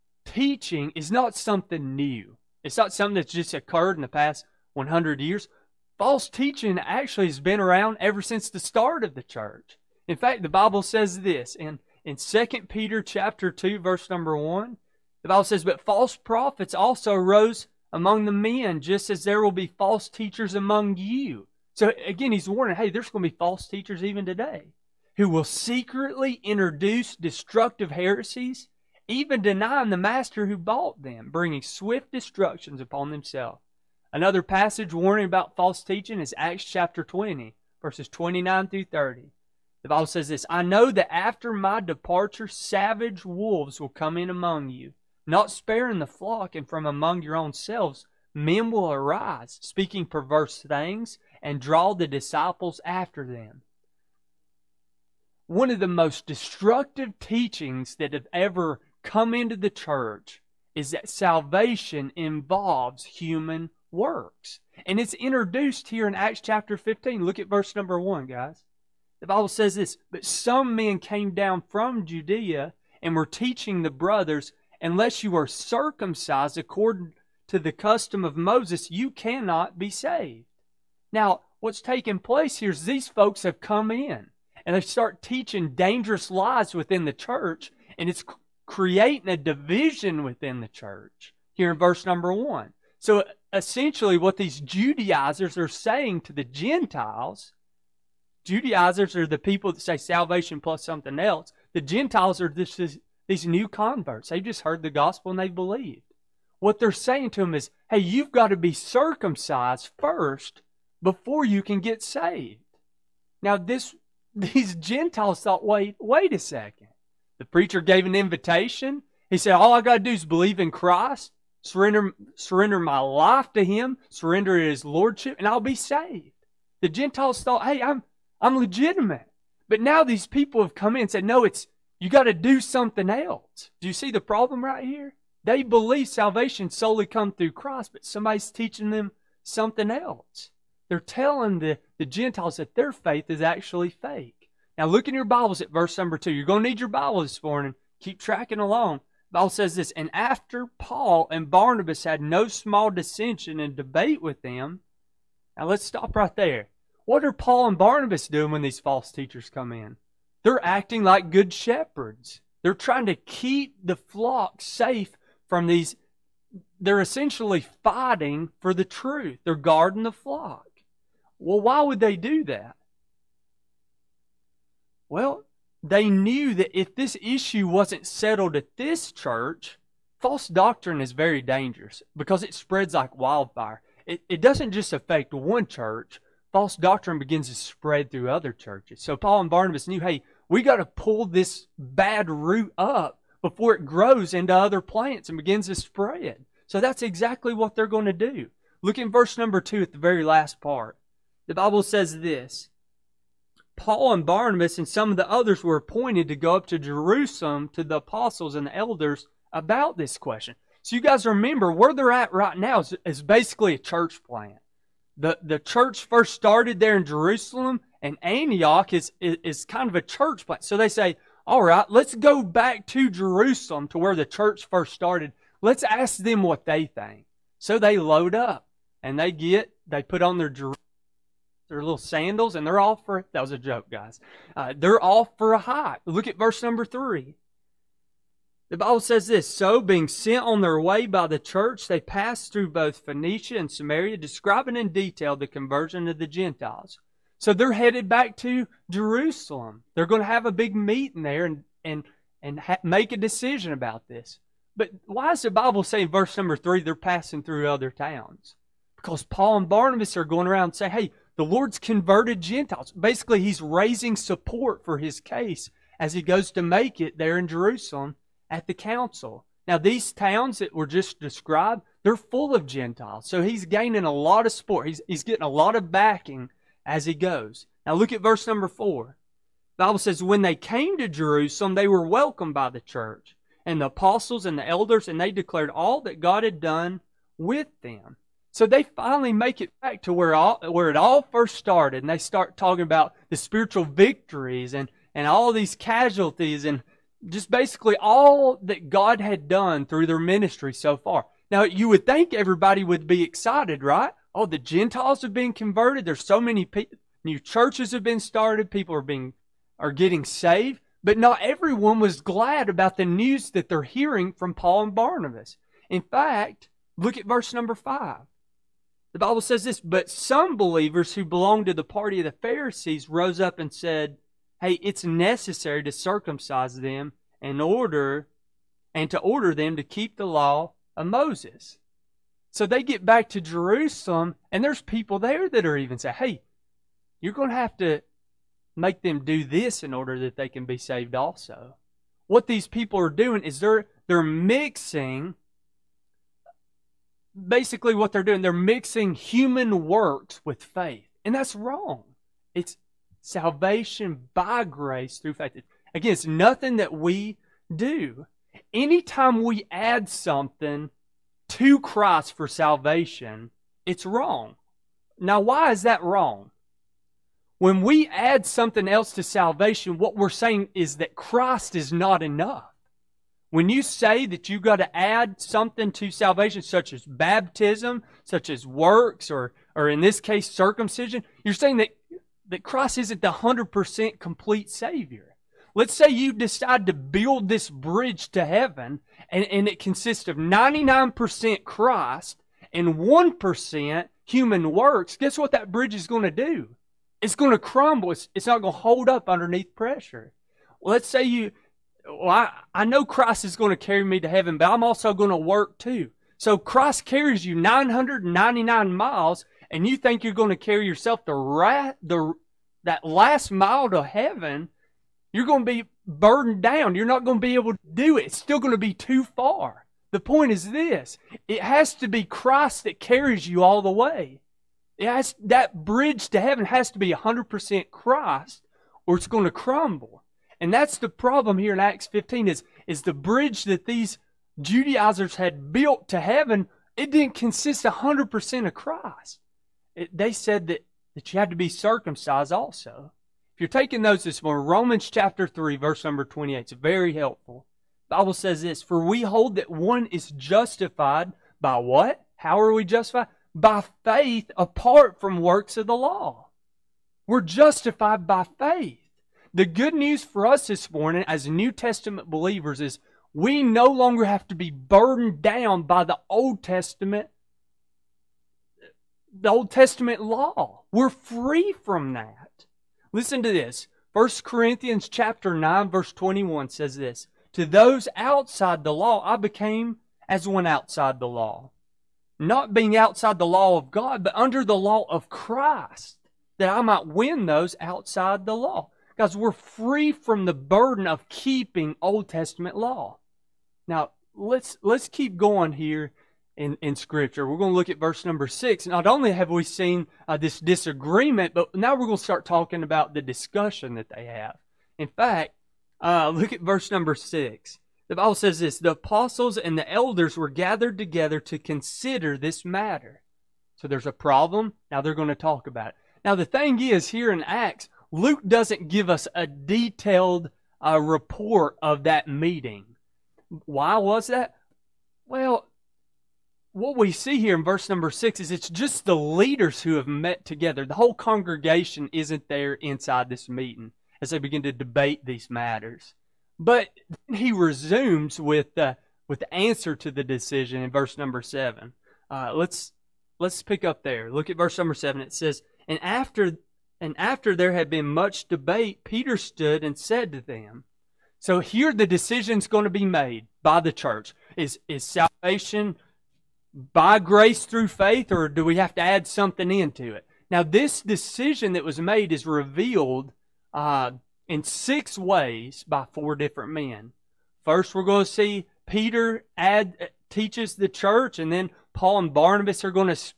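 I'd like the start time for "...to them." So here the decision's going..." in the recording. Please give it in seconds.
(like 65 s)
550 s.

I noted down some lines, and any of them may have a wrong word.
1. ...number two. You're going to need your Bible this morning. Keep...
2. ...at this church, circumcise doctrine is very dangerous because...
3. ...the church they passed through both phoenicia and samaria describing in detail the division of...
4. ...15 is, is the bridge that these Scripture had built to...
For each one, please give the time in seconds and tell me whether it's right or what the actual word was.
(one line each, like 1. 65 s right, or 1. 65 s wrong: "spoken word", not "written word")
1. 145 s right
2. 178 s wrong: "false", not "circumcise"
3. 241 s wrong: "conversion", not "division"
4. 432 s wrong: "Judaizers", not "Scripture".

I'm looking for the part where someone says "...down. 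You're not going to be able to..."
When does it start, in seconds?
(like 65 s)
416 s.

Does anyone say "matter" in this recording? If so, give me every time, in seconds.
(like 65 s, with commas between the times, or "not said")
512 s, 535 s.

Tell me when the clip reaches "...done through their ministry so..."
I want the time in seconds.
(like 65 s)
299 s.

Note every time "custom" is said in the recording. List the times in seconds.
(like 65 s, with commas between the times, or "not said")
77 s.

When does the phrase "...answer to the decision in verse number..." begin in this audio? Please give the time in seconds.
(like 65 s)
539 s.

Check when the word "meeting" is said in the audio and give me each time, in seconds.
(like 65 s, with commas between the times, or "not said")
250 s, 522 s, 533 s.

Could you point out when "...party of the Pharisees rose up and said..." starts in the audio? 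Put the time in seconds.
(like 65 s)
321 s.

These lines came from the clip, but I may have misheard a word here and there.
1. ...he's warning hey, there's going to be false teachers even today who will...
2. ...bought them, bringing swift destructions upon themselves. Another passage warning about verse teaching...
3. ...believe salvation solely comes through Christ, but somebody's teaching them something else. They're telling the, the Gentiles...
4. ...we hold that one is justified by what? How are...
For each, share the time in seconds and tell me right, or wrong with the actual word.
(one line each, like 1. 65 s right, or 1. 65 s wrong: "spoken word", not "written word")
1. 22 s right
2. 30 s wrong: "false", not "verse"
3. 135 s right
4. 449 s right.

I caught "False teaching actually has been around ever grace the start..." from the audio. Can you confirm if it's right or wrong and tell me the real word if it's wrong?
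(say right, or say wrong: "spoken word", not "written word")
wrong: "since", not "grace".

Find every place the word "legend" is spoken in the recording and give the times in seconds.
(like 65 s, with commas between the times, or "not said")
not said.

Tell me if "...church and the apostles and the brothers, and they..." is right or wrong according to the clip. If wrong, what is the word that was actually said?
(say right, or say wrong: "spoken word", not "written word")
wrong: "elders", not "brothers".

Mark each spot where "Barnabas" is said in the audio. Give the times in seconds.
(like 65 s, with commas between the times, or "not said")
151 s, 157 s, 189 s, 204 s, 259 s, 314 s, 572 s.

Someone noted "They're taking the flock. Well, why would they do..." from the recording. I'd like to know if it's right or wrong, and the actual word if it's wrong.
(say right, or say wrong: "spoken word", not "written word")
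wrong: "guarding", not "taking".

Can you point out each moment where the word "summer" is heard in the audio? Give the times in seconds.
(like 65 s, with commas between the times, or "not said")
not said.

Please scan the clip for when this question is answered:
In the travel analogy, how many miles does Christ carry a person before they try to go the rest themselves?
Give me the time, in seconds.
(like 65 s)
407 s.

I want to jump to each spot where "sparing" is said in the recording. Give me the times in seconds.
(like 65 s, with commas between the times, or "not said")
45 s.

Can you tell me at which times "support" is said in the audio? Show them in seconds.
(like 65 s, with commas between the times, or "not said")
264 s, 274 s.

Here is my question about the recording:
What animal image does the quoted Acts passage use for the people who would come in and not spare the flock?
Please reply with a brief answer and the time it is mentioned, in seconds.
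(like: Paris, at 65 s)
savage wolves, at 42 s.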